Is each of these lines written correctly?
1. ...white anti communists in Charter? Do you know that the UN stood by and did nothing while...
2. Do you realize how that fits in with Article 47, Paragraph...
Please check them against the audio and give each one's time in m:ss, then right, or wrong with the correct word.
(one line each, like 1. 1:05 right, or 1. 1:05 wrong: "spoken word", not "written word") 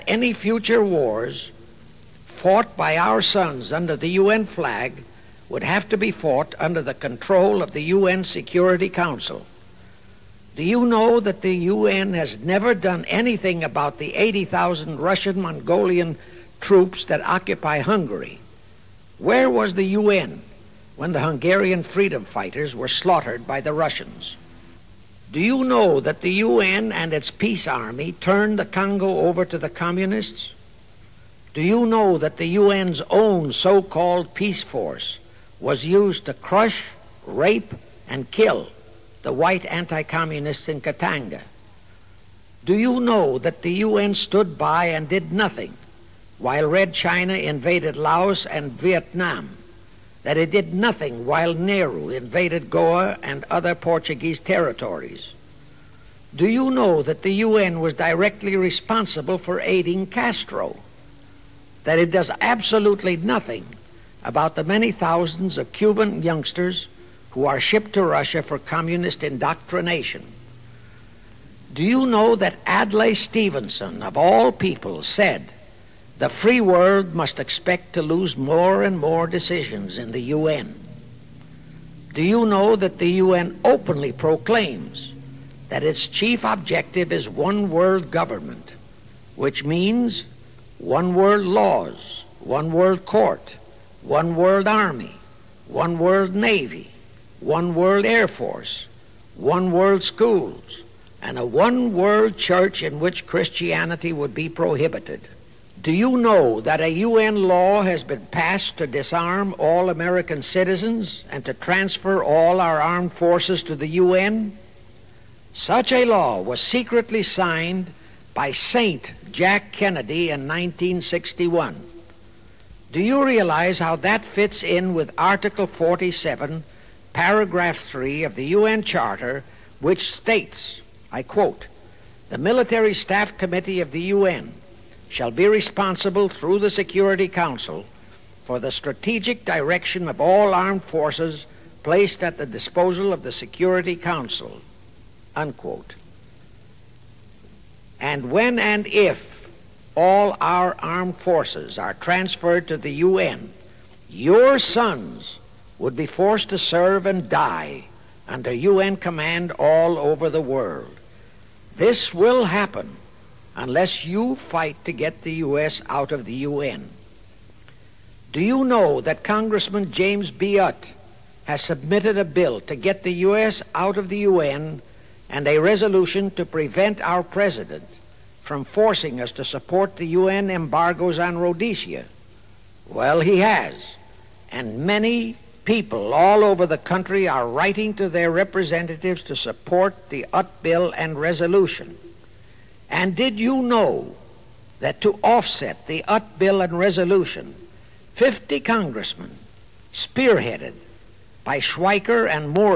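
1. 0:39 wrong: "Katanga", not "Charter"
2. 2:02 right.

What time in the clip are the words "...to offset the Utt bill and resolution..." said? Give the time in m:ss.
3:15.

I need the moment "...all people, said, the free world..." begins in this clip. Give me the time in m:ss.
1:14.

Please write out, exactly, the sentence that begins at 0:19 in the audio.
Where was the UN when the Hungarian freedom fighters were slaughtered by the Russians?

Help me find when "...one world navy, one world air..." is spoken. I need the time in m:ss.
1:35.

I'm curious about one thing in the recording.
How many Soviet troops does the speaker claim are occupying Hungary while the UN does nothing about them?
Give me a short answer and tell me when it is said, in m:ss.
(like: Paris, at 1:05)
80,000, at 0:14.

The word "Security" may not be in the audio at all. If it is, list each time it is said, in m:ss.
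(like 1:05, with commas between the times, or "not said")
0:08, 2:16, 2:23.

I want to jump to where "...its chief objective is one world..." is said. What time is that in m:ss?
1:25.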